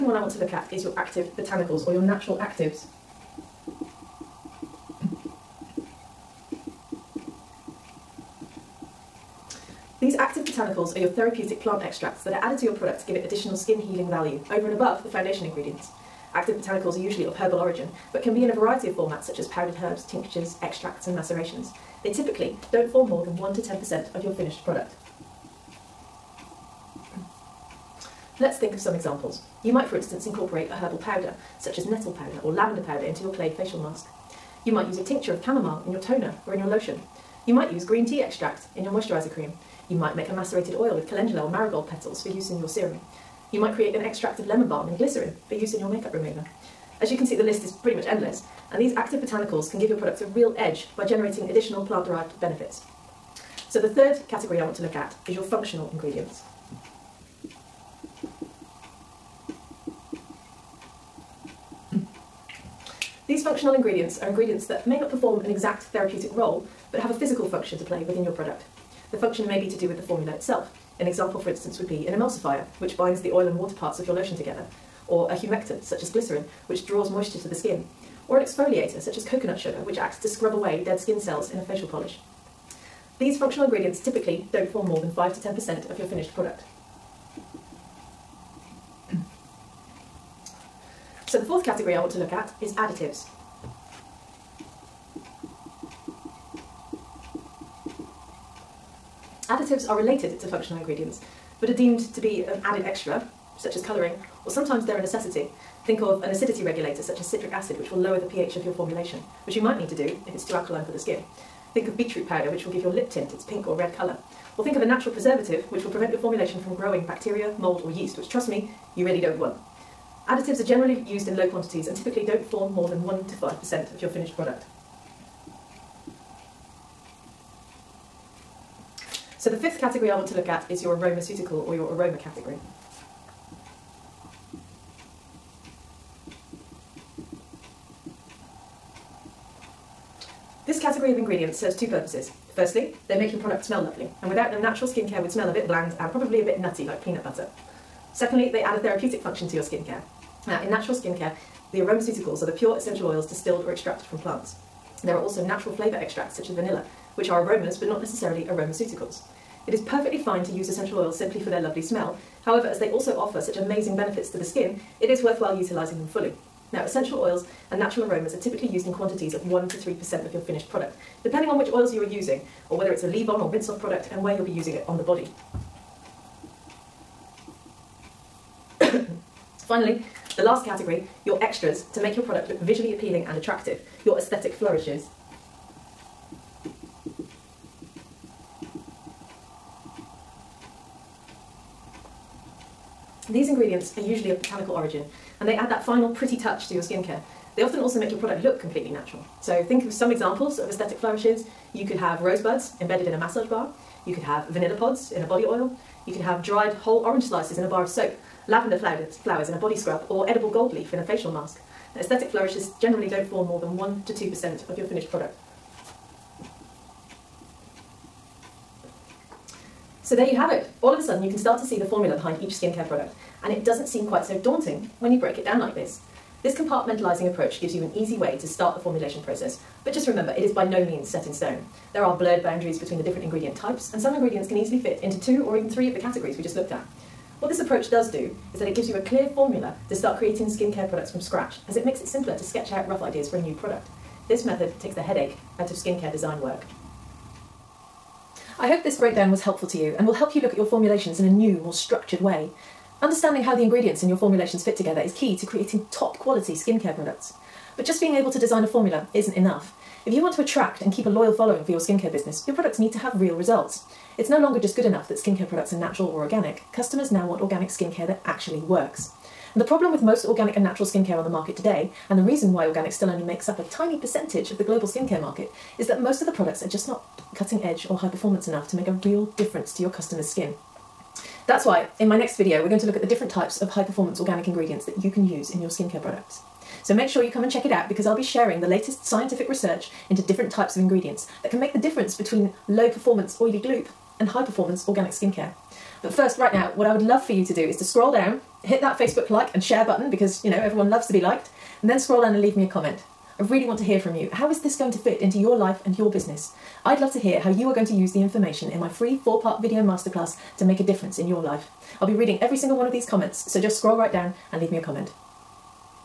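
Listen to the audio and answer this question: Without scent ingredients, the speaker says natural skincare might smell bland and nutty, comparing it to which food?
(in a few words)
peanut butter.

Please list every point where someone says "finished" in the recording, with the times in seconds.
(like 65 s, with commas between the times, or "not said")
24 s, 86 s, 124 s, 170 s, 214 s.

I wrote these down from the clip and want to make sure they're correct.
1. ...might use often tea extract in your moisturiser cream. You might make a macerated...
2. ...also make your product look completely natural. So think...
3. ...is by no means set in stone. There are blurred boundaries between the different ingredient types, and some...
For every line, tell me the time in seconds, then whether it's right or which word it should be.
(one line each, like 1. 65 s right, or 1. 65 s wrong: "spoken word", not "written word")
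1. 37 s wrong: "green", not "often"
2. 197 s right
3. 230 s right.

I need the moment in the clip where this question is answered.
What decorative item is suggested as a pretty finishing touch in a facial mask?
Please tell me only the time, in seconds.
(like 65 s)
210 s.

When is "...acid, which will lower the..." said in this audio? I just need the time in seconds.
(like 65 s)
107 s.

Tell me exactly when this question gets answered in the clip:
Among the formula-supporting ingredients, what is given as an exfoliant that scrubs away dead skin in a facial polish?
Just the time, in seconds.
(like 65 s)
79 s.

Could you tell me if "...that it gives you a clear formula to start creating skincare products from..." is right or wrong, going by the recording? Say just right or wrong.
right.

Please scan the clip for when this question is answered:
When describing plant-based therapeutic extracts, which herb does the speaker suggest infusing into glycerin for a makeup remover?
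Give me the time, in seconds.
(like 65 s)
44 s.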